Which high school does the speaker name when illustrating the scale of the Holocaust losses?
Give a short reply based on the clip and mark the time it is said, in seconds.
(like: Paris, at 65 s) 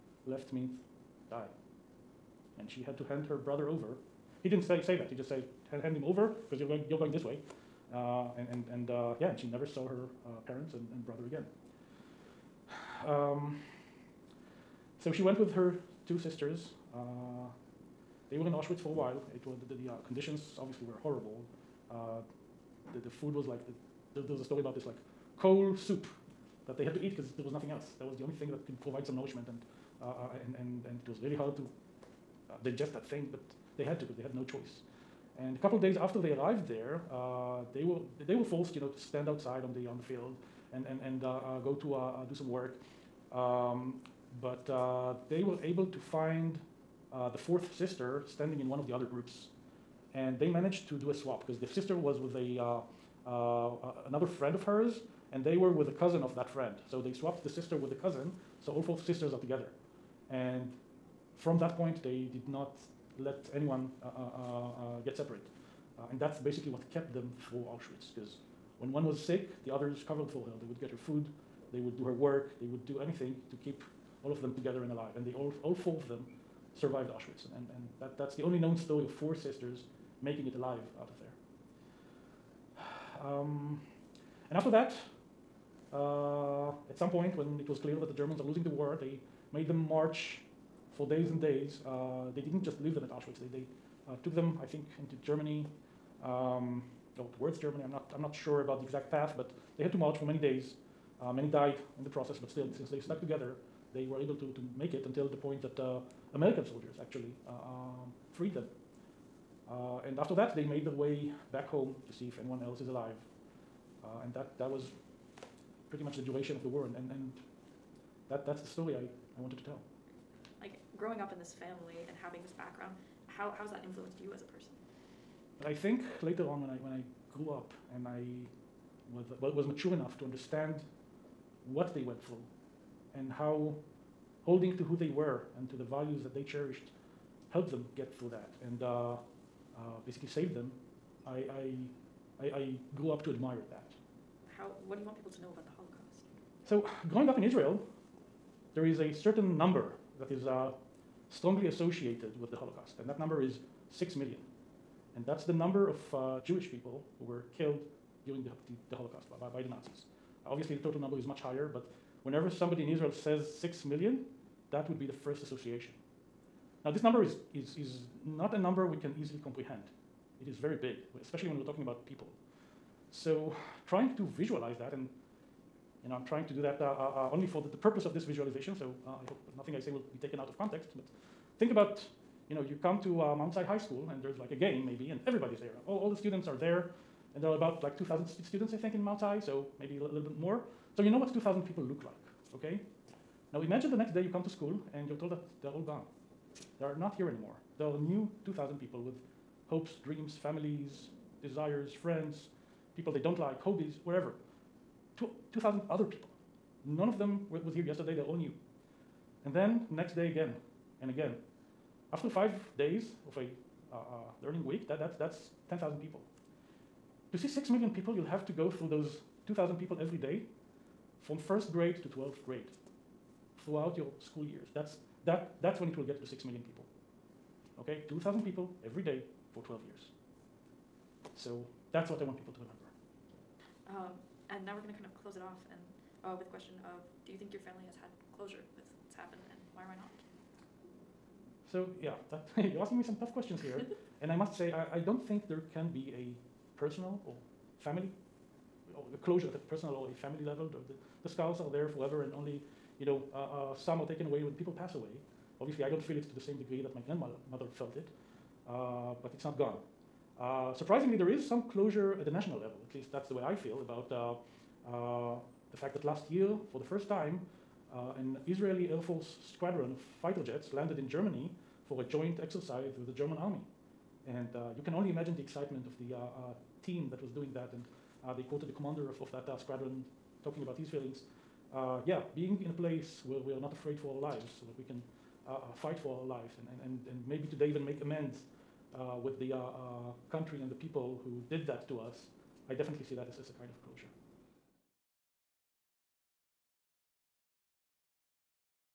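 Mount Sinai High School, at 183 s.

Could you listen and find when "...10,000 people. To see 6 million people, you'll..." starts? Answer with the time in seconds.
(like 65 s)
215 s.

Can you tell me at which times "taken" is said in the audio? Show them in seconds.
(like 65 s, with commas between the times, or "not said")
180 s, 254 s.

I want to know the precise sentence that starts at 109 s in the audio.
Uh, and after that, they made their way back home to see if anyone else is alive.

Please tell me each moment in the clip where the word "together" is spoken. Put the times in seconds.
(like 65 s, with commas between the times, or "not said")
59 s, 74 s, 103 s.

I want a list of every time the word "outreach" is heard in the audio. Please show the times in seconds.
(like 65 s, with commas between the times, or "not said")
not said.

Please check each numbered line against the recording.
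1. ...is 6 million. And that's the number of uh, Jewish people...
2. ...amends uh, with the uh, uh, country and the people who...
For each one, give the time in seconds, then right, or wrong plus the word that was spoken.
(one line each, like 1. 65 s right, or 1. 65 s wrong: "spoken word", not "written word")
1. 153 s right
2. 288 s right.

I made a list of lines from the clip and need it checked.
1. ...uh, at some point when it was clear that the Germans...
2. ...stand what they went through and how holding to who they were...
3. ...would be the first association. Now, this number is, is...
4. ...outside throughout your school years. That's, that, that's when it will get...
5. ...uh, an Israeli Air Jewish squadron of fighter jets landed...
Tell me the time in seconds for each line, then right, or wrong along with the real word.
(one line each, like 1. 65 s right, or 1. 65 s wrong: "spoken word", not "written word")
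1. 85 s right
2. 130 s wrong: "understand", not "stand"
3. 164 s right
4. 222 s wrong: "grade", not "outside"
5. 267 s wrong: "Force", not "Jewish".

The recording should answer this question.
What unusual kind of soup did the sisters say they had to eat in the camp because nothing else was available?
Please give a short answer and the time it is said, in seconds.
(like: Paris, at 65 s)
coal soup, at 25 s.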